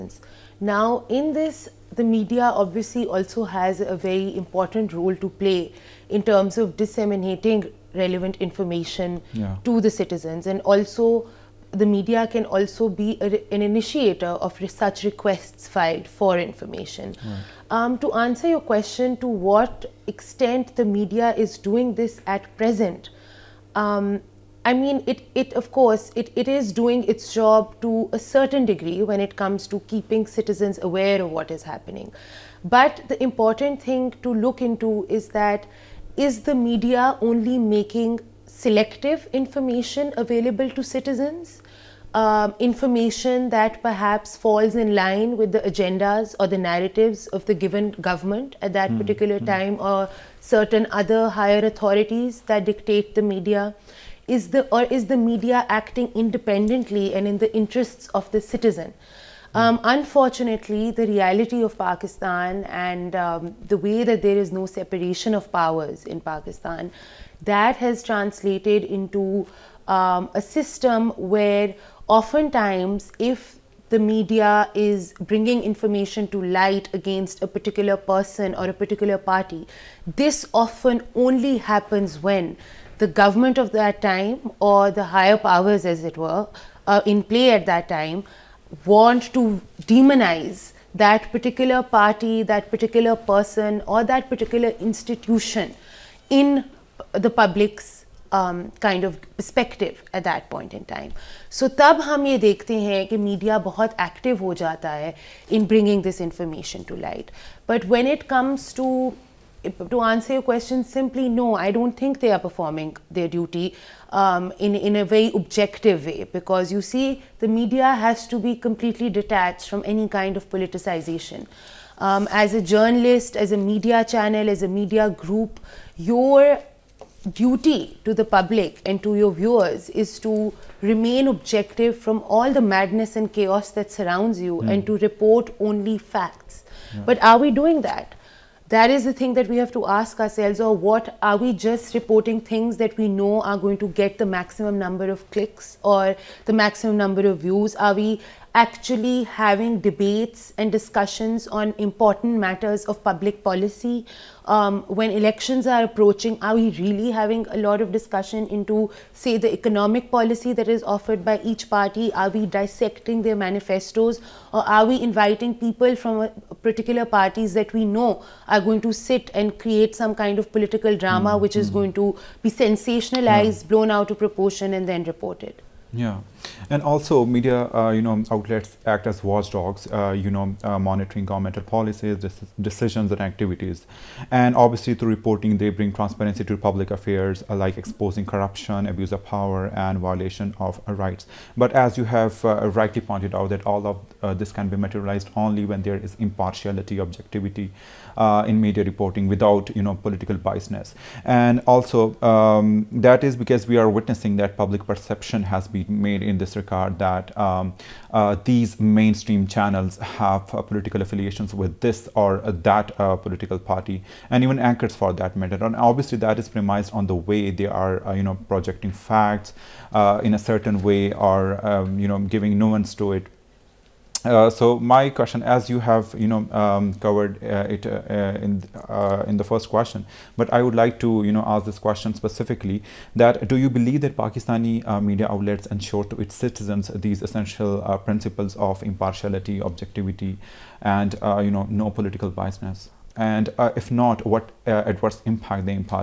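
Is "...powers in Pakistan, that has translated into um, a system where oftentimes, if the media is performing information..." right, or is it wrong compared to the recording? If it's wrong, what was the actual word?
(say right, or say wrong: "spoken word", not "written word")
wrong: "bringing", not "performing".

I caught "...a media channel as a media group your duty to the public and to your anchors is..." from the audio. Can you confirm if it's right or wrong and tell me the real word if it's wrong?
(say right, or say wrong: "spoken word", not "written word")
wrong: "viewers", not "anchors".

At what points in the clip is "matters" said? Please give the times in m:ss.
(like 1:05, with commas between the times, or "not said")
2:32, 3:35.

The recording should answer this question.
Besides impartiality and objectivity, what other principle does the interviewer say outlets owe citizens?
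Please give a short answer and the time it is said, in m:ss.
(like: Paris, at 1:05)
No political biasness, at 4:01.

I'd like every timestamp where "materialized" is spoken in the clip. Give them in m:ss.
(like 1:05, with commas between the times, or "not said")
3:14.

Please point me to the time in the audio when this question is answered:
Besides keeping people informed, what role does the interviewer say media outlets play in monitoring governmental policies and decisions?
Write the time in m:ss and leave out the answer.
2:59.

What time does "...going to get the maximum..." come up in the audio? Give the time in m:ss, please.
2:23.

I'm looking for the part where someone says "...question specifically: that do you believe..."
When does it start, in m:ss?
3:51.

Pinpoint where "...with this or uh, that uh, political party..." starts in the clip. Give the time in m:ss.
3:31.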